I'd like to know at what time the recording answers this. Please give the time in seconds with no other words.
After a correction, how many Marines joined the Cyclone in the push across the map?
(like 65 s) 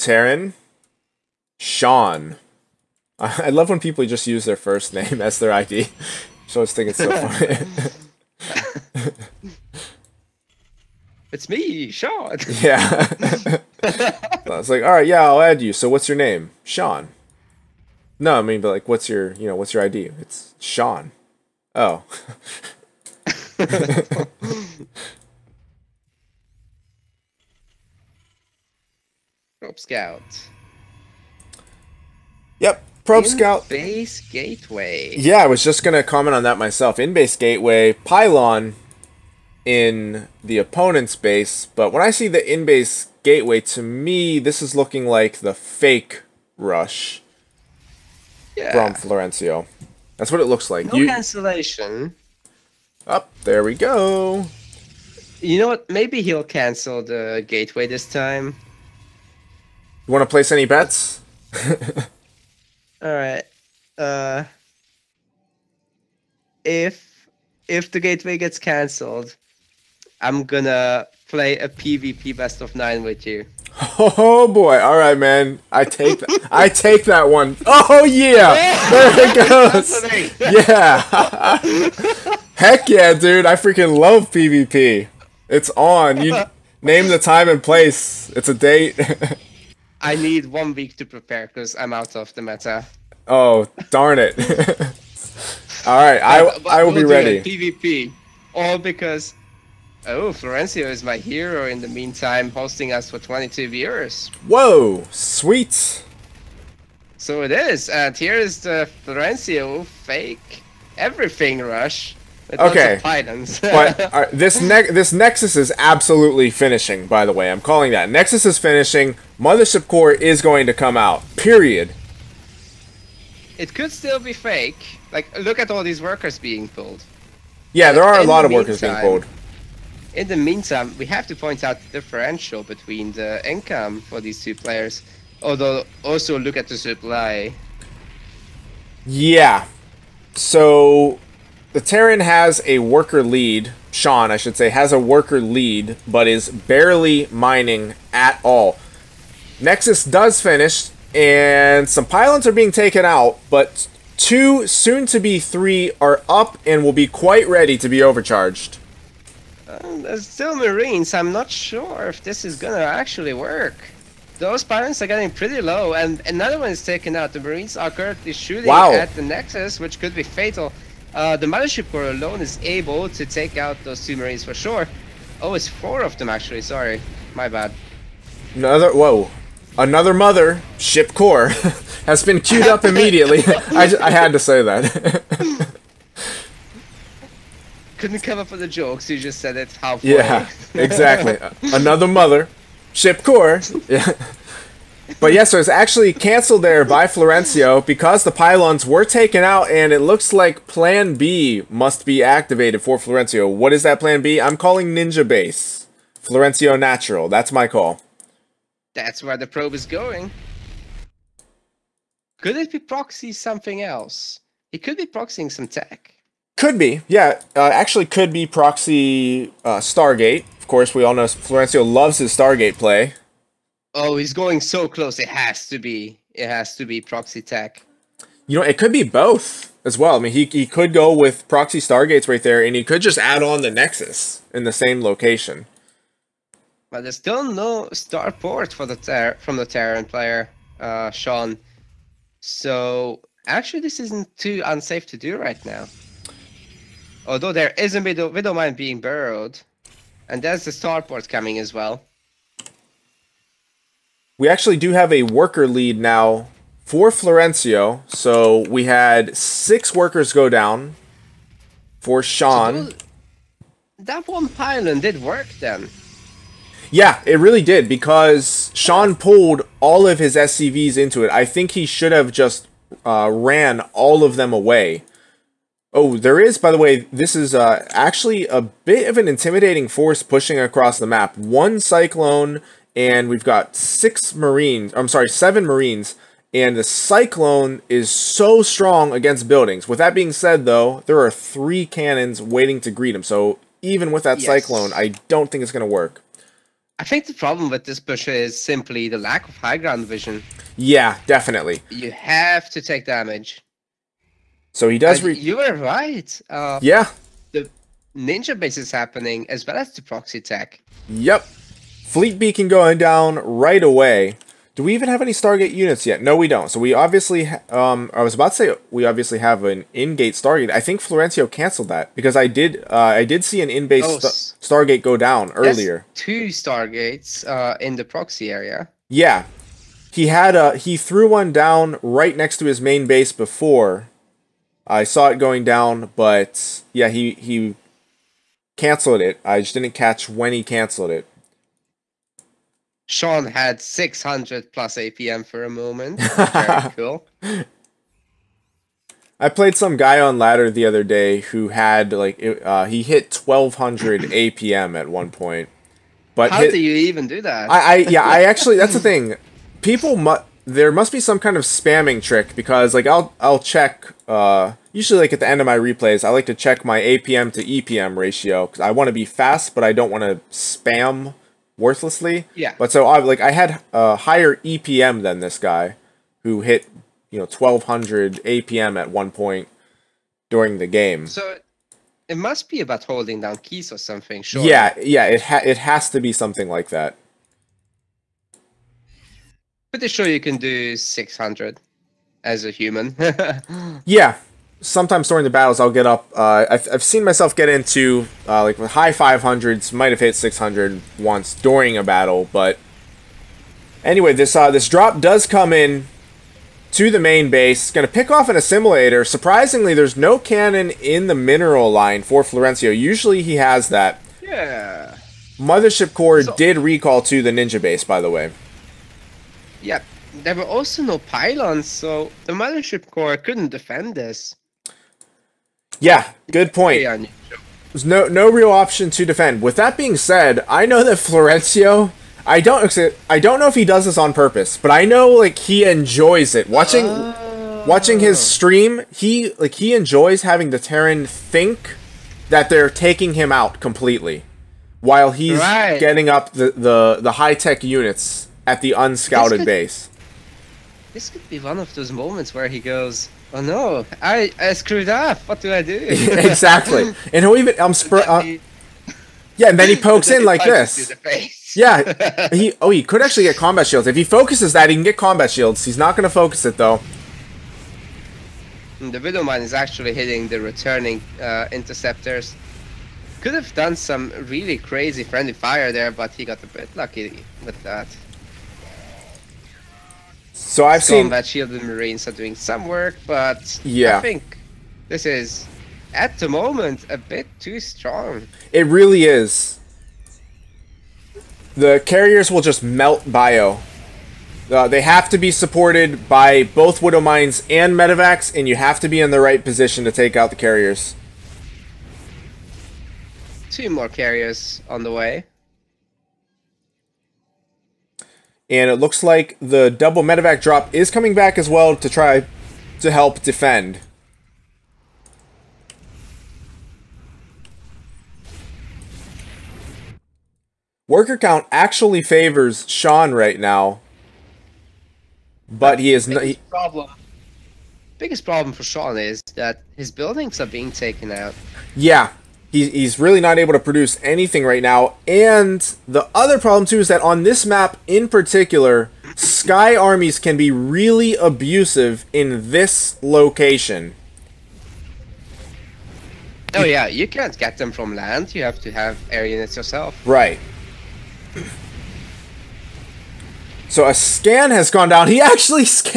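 285 s.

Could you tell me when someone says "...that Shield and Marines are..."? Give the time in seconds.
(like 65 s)
481 s.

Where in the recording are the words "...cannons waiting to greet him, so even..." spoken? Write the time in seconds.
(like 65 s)
291 s.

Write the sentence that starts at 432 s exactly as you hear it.
I don't I don't know if he does this on purpose, but I know like he enjoys it.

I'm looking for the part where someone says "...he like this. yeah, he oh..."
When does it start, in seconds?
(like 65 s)
460 s.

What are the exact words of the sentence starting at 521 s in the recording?
Worker count actually favors Sean right now.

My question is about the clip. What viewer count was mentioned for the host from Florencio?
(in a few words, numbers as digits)
22.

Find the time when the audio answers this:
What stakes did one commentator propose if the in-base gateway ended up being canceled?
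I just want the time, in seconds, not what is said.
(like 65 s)
71 s.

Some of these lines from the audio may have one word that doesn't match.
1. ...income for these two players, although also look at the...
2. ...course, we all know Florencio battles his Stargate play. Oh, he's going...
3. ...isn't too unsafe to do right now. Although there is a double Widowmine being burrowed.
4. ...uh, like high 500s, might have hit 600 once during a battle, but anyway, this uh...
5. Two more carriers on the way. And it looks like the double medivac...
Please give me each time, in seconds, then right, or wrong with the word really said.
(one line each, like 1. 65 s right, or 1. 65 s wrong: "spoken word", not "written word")
1. 133 s right
2. 220 s wrong: "loves", not "battles"
3. 243 s wrong: "middle", not "double"
4. 398 s right
5. 503 s right.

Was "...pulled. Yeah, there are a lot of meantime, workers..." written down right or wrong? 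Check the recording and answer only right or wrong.
right.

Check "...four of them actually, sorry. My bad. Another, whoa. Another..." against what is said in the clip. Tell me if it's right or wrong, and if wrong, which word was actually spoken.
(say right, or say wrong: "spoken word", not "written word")
right.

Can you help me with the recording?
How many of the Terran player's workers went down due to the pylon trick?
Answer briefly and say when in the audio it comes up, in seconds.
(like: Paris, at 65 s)
6, at 259 s.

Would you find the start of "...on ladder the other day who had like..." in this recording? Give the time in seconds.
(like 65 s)
350 s.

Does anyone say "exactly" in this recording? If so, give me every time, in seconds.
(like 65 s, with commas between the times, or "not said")
190 s, 456 s.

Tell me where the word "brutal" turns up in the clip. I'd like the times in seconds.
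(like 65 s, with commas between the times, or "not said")
not said.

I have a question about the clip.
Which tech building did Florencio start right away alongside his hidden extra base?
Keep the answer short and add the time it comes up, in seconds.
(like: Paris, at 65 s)
Fleet beacon, at 312 s.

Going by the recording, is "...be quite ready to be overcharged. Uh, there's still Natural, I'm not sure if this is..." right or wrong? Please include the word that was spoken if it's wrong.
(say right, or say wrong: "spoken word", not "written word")
wrong: "Marines", not "Natural".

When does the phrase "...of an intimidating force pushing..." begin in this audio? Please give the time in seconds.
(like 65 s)
279 s.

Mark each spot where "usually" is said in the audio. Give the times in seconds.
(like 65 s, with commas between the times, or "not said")
364 s, 412 s.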